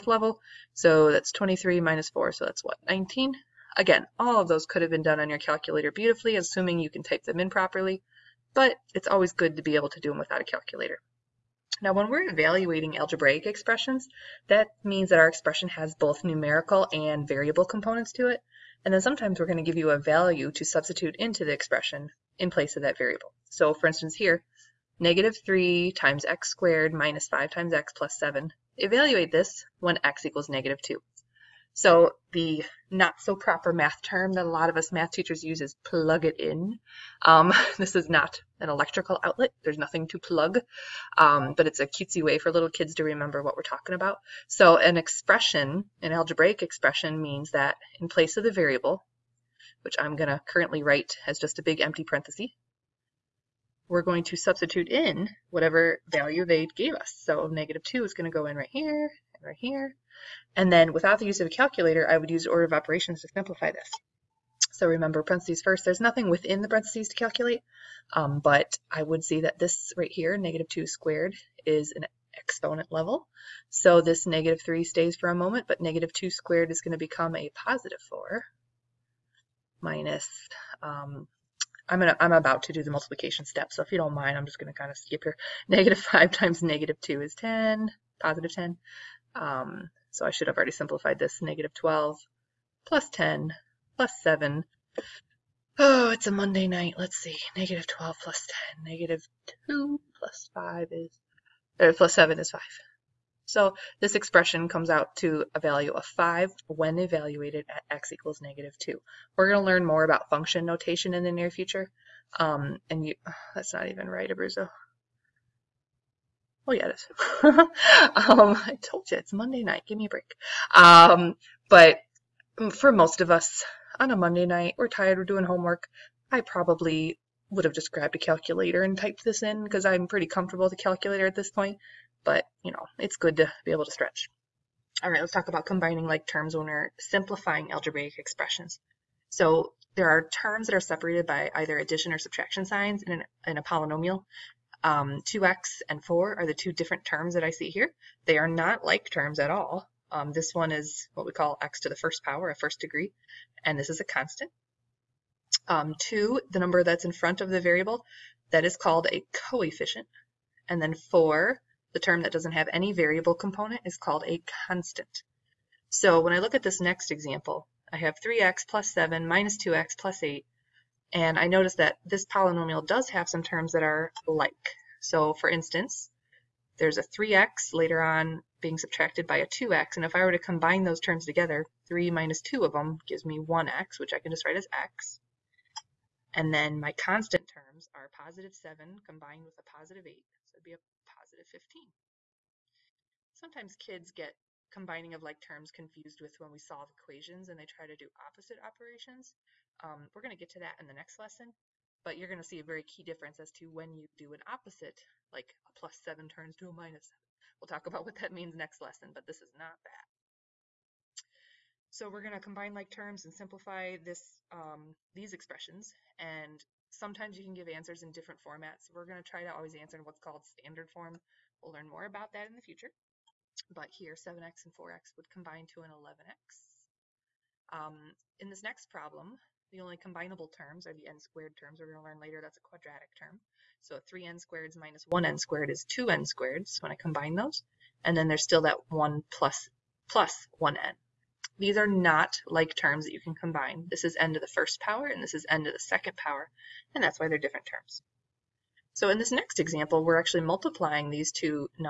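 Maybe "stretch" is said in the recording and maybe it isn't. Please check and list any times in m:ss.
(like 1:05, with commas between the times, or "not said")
2:13.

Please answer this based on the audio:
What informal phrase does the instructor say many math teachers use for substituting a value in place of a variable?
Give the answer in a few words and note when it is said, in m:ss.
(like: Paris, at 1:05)
plug it in, at 0:35.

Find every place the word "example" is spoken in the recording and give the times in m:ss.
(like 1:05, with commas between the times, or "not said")
2:47, 4:09.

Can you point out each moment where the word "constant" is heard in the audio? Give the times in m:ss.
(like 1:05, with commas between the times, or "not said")
2:34, 2:44, 3:06.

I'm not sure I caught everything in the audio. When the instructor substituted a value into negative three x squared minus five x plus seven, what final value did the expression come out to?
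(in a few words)
5.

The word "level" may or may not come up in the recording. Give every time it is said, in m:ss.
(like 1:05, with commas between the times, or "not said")
0:00, 1:12.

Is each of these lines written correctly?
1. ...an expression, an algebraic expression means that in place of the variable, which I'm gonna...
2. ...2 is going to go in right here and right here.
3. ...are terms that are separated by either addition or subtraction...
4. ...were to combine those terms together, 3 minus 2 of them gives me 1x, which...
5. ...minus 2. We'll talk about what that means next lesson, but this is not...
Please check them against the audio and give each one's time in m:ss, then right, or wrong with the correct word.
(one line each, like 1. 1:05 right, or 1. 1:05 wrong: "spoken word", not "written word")
1. 0:44 right
2. 0:57 right
3. 2:20 right
4. 3:00 right
5. 3:26 wrong: "7", not "2".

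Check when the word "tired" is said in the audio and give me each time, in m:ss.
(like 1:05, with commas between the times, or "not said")
2:04.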